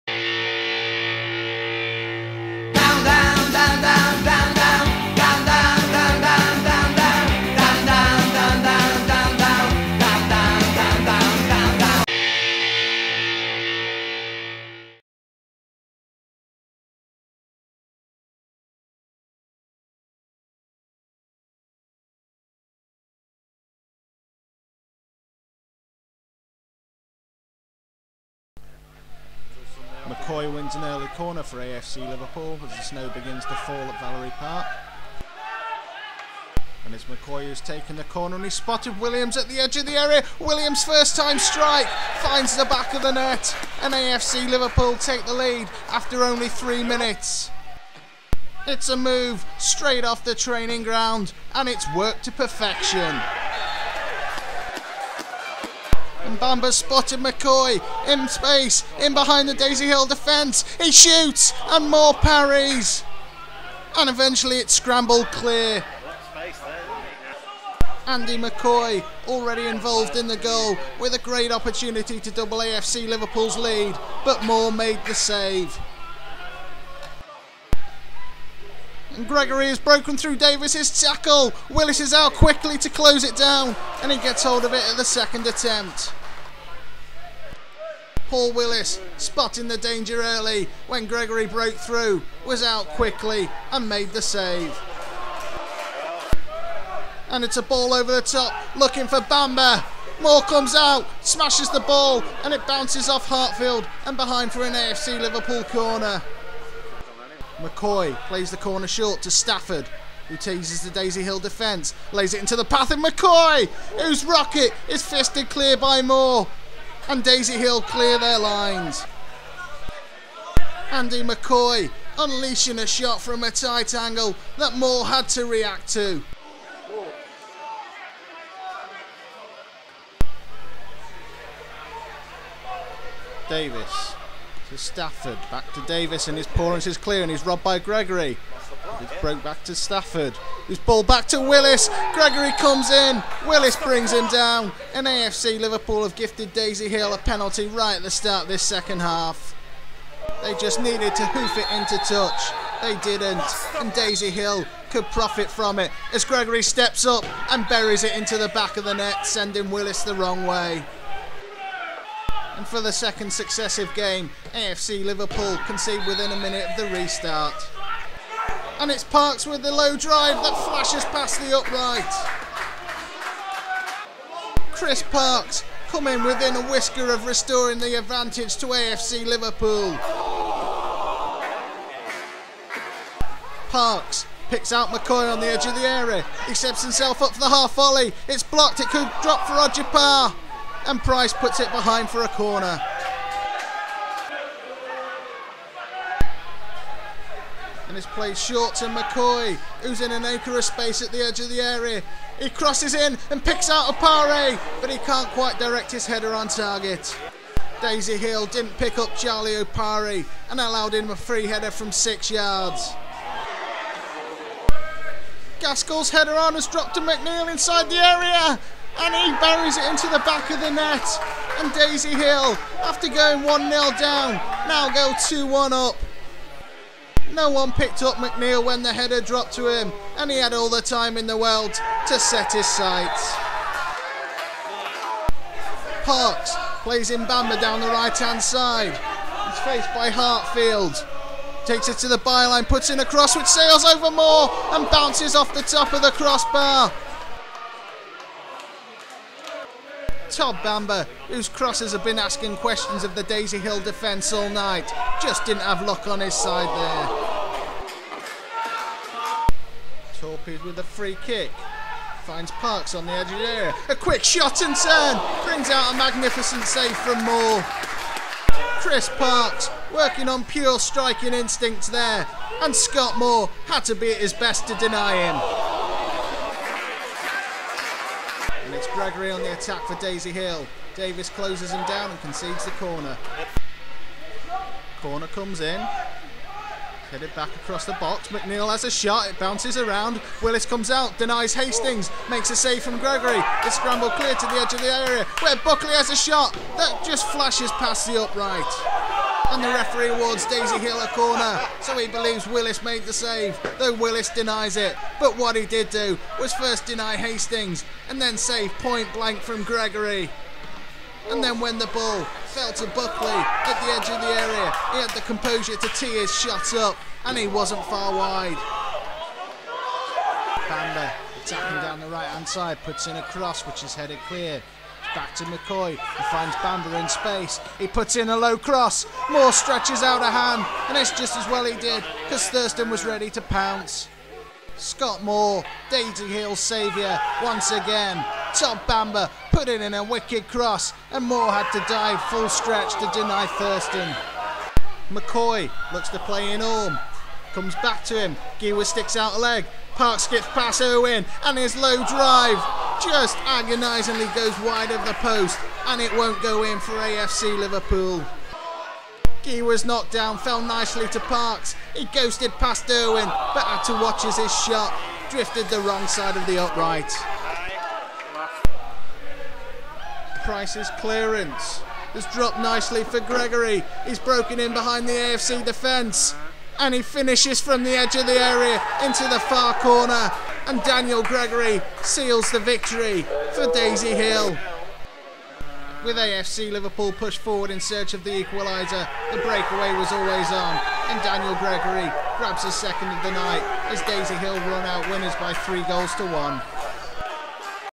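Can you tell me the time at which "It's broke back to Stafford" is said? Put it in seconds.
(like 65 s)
138 s.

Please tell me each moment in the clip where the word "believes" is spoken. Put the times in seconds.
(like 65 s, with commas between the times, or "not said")
302 s.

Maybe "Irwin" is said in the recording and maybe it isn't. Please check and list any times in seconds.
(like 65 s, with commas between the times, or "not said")
350 s, 362 s.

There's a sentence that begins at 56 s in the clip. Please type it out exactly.
Mbamba spotted McCoy in space, in behind the Daisy Hill defence.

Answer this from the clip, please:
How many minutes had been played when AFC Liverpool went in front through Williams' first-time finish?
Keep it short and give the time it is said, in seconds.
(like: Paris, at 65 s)
3, at 46 s.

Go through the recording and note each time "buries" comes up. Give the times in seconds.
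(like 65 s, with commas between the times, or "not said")
157 s, 219 s.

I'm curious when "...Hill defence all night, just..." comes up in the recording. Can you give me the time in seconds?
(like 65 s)
253 s.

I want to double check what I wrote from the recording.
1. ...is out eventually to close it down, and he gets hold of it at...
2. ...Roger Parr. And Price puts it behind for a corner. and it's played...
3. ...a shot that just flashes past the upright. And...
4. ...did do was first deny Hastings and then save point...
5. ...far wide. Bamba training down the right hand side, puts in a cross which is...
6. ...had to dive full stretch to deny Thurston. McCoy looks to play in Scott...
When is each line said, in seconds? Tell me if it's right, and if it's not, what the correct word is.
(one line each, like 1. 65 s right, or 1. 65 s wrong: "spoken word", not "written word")
1. 81 s wrong: "quickly", not "eventually"
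2. 189 s right
3. 296 s right
4. 305 s right
5. 317 s wrong: "attacking", not "training"
6. 341 s wrong: "Orm", not "Scott".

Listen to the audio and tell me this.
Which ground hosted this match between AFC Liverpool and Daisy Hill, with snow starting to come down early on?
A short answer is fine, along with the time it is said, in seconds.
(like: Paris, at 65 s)
Valerie Park, at 33 s.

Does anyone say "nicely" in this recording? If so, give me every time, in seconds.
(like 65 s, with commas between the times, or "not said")
360 s, 372 s.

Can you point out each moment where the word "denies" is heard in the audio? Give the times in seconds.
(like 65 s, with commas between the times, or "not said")
291 s, 304 s.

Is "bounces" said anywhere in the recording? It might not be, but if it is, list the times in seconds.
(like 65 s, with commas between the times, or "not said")
102 s, 244 s, 289 s.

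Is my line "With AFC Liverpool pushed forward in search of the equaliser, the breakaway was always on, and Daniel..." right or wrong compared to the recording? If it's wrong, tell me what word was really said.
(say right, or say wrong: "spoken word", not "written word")
right.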